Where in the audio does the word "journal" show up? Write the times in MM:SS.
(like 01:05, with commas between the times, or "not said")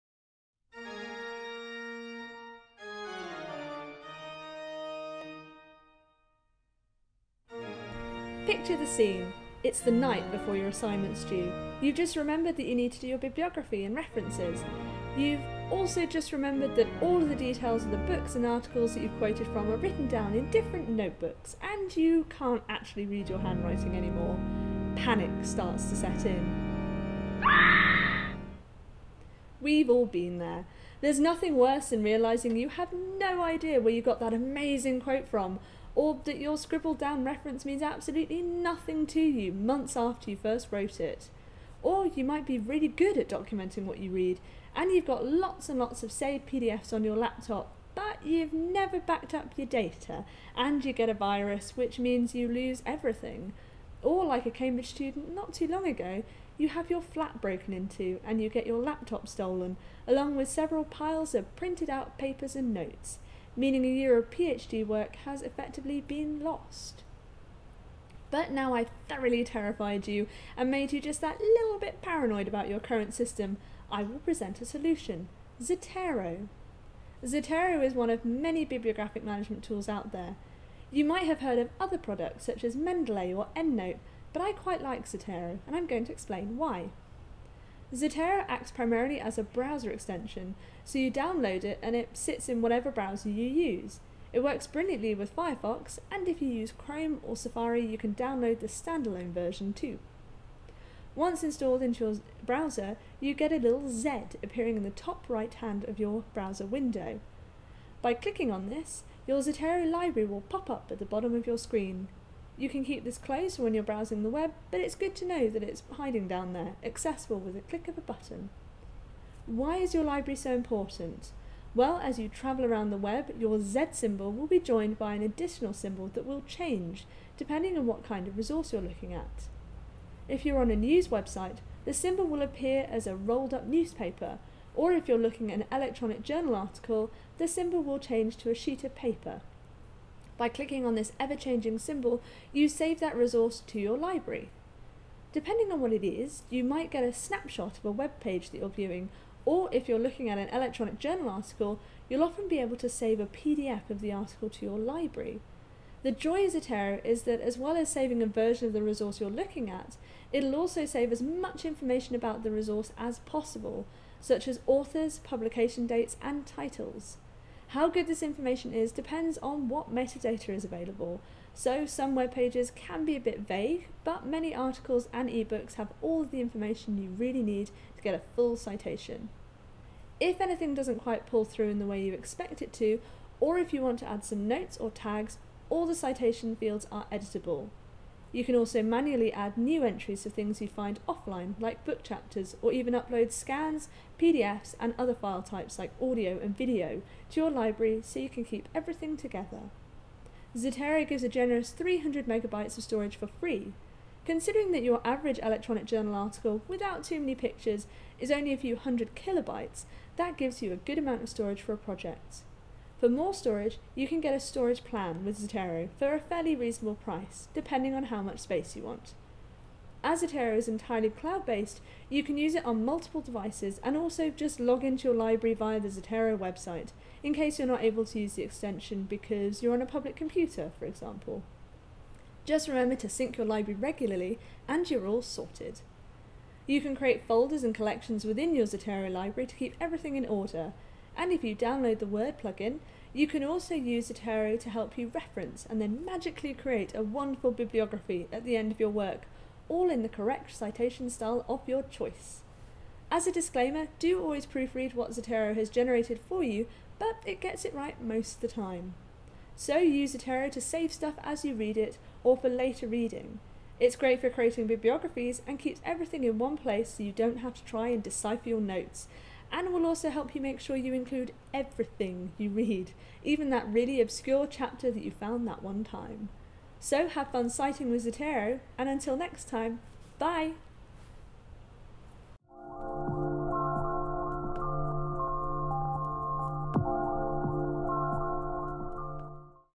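02:16, 02:30, 03:25.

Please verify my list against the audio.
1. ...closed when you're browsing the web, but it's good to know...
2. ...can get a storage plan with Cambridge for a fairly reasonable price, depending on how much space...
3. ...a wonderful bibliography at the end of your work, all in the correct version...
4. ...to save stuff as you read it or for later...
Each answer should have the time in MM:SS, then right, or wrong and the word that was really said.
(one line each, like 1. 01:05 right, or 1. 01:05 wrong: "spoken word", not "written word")
1. 01:53 right
2. 03:34 wrong: "Zotero", not "Cambridge"
3. 04:06 wrong: "citation", not "version"
4. 04:20 right.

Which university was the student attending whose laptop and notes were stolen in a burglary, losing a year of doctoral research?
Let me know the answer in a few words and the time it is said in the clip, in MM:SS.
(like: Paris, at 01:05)
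Cambridge, at 00:54.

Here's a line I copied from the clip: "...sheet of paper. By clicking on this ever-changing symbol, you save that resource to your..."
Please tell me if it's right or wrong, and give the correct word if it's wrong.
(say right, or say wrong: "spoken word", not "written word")
right.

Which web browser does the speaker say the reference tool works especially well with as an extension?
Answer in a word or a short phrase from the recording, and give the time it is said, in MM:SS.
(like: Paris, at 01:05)
Firefox, at 01:35.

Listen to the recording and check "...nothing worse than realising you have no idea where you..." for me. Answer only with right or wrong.
right.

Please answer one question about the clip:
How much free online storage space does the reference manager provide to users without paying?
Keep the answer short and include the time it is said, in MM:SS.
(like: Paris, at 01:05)
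300 megabytes, at 03:21.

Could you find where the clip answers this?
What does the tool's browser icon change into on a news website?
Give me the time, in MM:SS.
02:13.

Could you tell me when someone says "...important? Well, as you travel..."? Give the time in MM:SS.
02:00.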